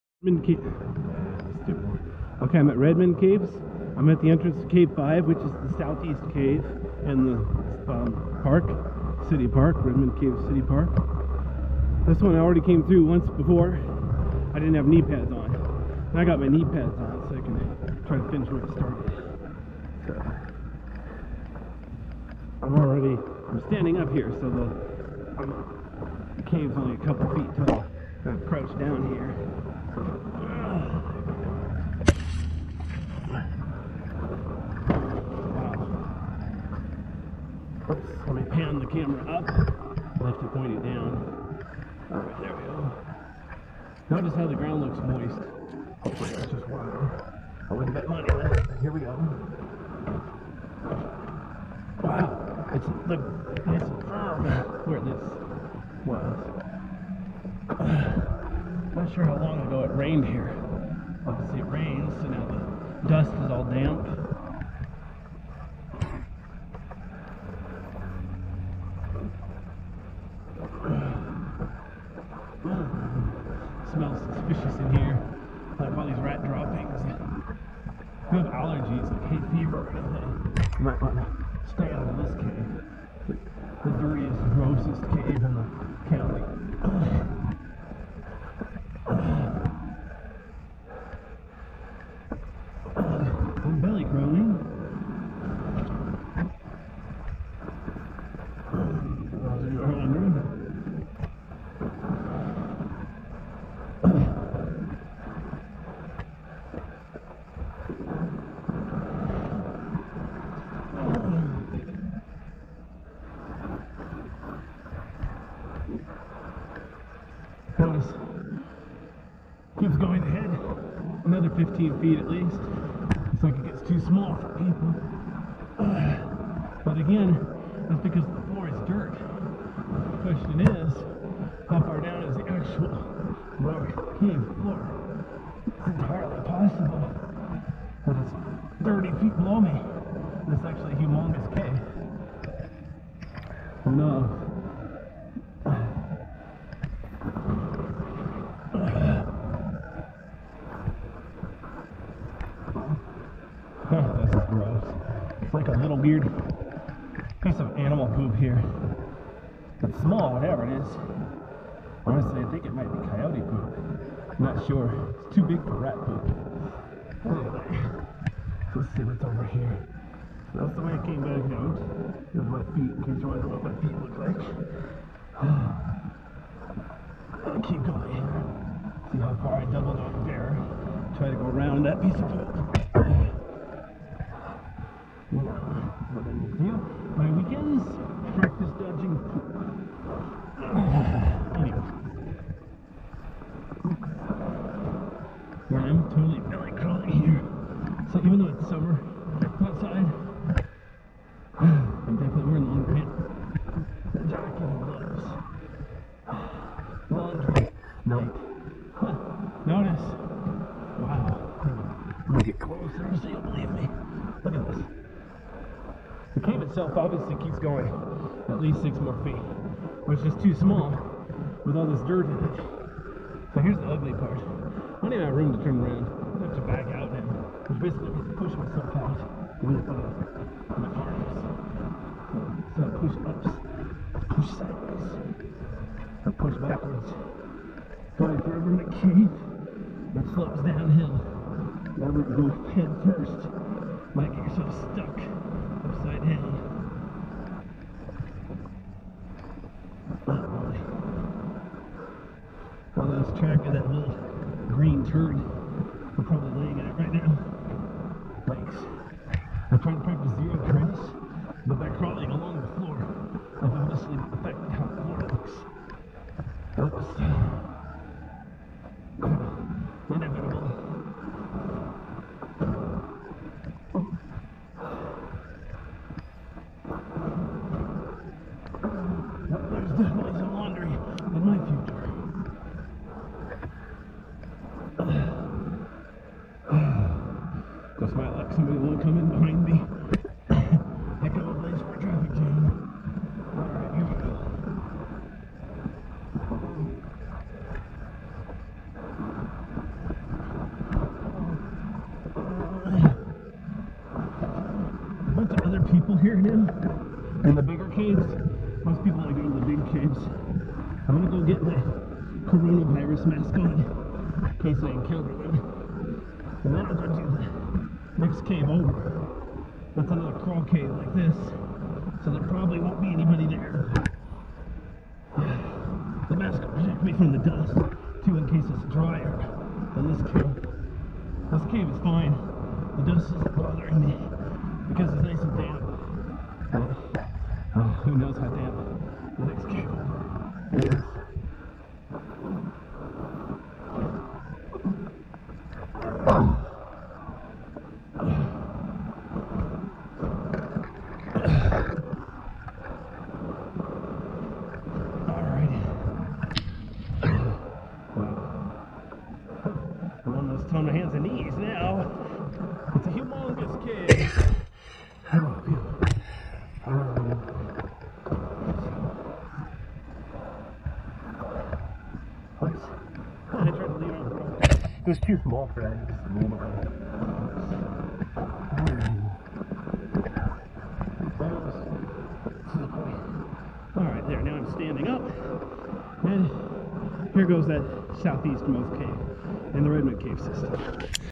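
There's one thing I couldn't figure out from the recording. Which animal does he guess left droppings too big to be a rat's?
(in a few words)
coyote.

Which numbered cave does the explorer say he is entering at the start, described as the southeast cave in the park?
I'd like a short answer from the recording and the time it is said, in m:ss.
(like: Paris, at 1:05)
Cave 5, at 0:04.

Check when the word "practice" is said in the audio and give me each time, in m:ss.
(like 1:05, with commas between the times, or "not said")
3:08, 4:20.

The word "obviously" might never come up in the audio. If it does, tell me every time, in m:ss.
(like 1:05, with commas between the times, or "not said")
1:01, 3:36, 4:23.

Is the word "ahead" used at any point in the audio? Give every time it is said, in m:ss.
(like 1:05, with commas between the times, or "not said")
2:00.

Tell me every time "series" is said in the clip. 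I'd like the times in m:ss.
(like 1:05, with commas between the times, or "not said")
not said.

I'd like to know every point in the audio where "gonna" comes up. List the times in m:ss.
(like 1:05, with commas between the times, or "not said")
3:32, 5:11.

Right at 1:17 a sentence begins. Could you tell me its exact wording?
If you have allergies, like hay fever or anything, you might want to stay out of this cave.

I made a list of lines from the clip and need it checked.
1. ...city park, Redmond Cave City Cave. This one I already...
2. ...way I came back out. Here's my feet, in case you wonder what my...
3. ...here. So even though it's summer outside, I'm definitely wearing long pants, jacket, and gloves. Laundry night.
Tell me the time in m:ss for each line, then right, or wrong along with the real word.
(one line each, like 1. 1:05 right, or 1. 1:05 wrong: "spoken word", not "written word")
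1. 0:09 wrong: "Park", not "Cave"
2. 2:50 right
3. 3:17 right.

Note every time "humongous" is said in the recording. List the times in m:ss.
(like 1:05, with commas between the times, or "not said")
2:20, 6:03.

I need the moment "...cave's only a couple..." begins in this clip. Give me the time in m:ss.
0:26.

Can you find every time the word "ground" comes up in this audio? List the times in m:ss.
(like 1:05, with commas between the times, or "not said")
0:44.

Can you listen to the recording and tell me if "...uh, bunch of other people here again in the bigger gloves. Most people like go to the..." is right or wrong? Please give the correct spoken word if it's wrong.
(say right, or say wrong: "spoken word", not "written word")
wrong: "caves", not "gloves".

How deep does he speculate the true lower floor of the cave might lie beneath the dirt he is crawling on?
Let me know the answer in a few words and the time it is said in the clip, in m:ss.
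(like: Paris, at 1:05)
30 feet, at 2:18.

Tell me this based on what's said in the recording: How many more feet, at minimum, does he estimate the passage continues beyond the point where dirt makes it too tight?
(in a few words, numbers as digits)
6.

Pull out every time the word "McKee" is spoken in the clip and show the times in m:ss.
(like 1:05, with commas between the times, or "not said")
3:58.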